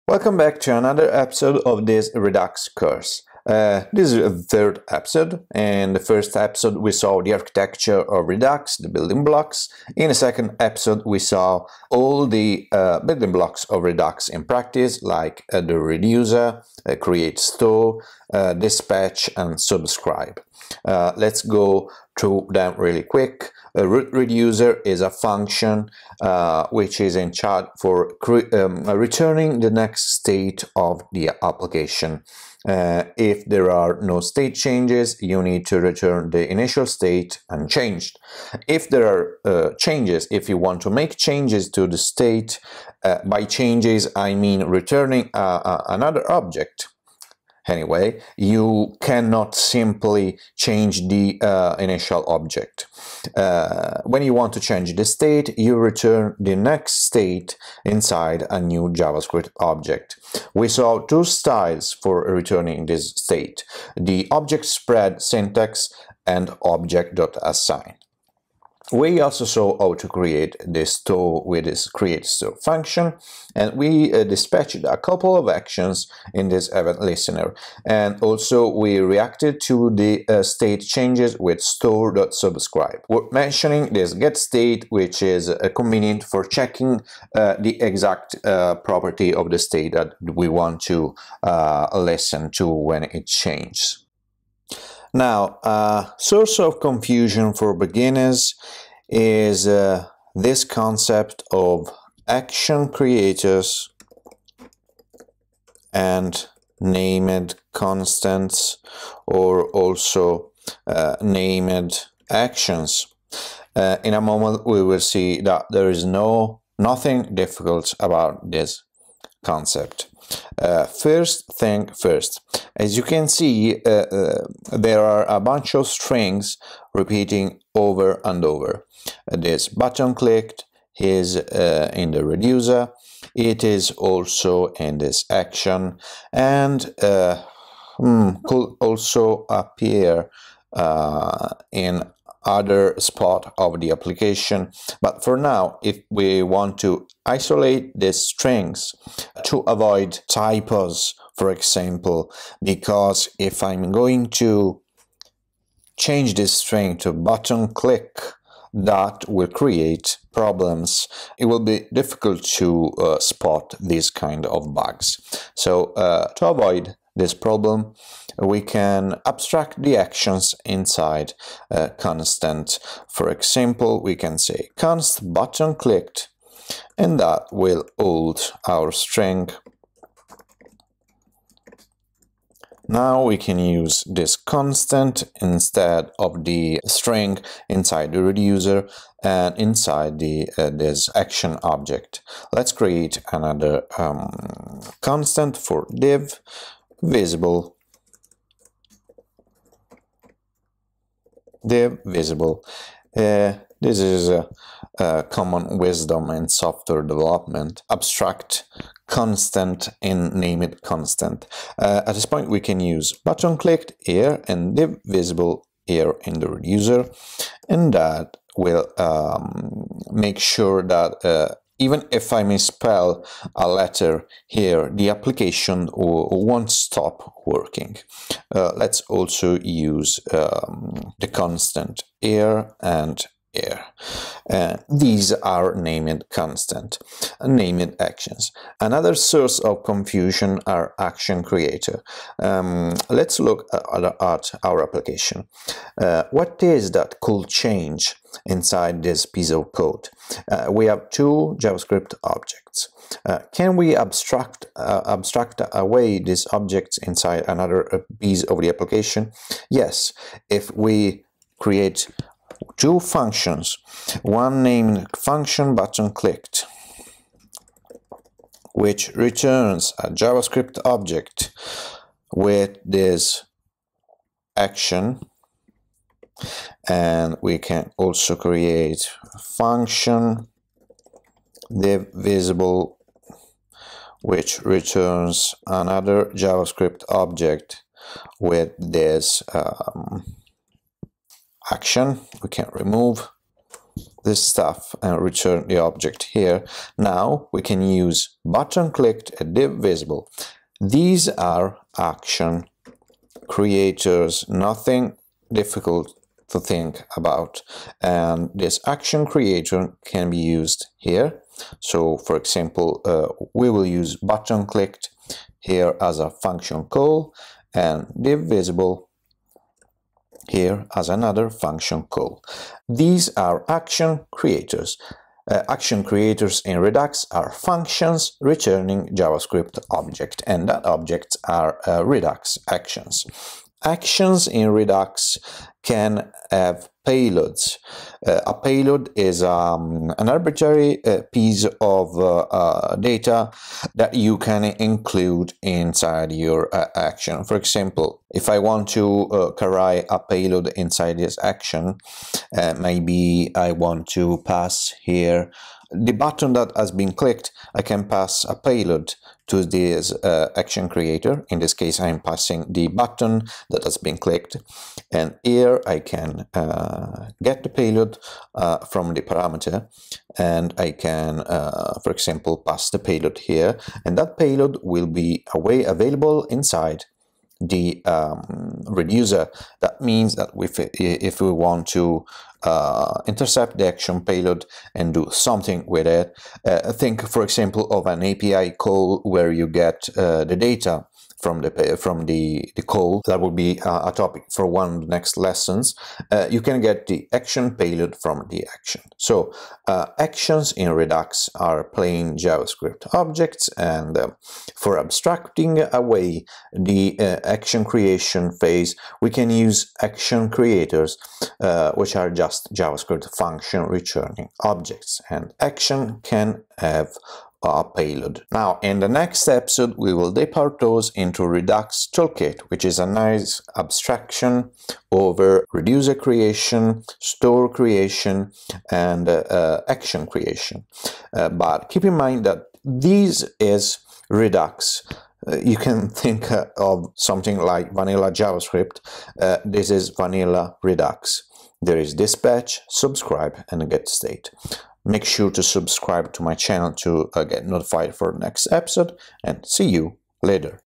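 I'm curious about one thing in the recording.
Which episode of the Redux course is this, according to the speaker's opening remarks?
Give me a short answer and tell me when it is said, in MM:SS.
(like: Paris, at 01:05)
Third, at 00:03.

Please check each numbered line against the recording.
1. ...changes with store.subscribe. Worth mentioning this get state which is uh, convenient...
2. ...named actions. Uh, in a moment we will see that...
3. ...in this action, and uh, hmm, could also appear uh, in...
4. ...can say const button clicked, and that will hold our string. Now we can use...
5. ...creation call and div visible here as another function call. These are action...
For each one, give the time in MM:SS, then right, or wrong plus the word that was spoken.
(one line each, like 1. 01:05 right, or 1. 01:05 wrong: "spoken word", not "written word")
1. 01:20 right
2. 01:51 right
3. 02:14 right
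4. 02:54 right
5. 05:16 wrong: "function", not "creation".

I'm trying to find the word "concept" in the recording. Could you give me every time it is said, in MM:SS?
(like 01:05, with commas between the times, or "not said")
01:40, 01:59.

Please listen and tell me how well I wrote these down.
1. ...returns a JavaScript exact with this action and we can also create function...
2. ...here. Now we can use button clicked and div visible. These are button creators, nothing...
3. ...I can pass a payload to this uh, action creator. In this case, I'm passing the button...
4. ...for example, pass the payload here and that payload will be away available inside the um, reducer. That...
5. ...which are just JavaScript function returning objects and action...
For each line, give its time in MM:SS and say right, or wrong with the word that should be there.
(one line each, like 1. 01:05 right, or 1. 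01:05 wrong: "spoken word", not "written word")
1. 04:29 wrong: "object", not "exact"
2. 04:56 wrong: "action", not "button"
3. 05:57 right
4. 06:12 right
5. 06:51 right.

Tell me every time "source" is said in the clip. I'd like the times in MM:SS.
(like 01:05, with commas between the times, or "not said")
01:36, 03:59.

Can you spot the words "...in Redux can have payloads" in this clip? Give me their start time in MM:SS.
05:34.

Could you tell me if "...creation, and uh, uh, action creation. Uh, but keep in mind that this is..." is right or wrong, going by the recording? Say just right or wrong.
right.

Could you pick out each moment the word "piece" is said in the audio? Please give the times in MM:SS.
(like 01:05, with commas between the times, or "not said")
04:09, 04:18, 05:41.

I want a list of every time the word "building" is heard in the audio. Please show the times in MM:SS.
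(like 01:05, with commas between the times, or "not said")
00:08, 00:13.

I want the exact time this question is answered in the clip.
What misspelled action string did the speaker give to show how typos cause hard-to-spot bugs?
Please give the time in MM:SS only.
02:37.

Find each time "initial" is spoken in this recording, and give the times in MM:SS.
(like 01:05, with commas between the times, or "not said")
00:36, 00:51.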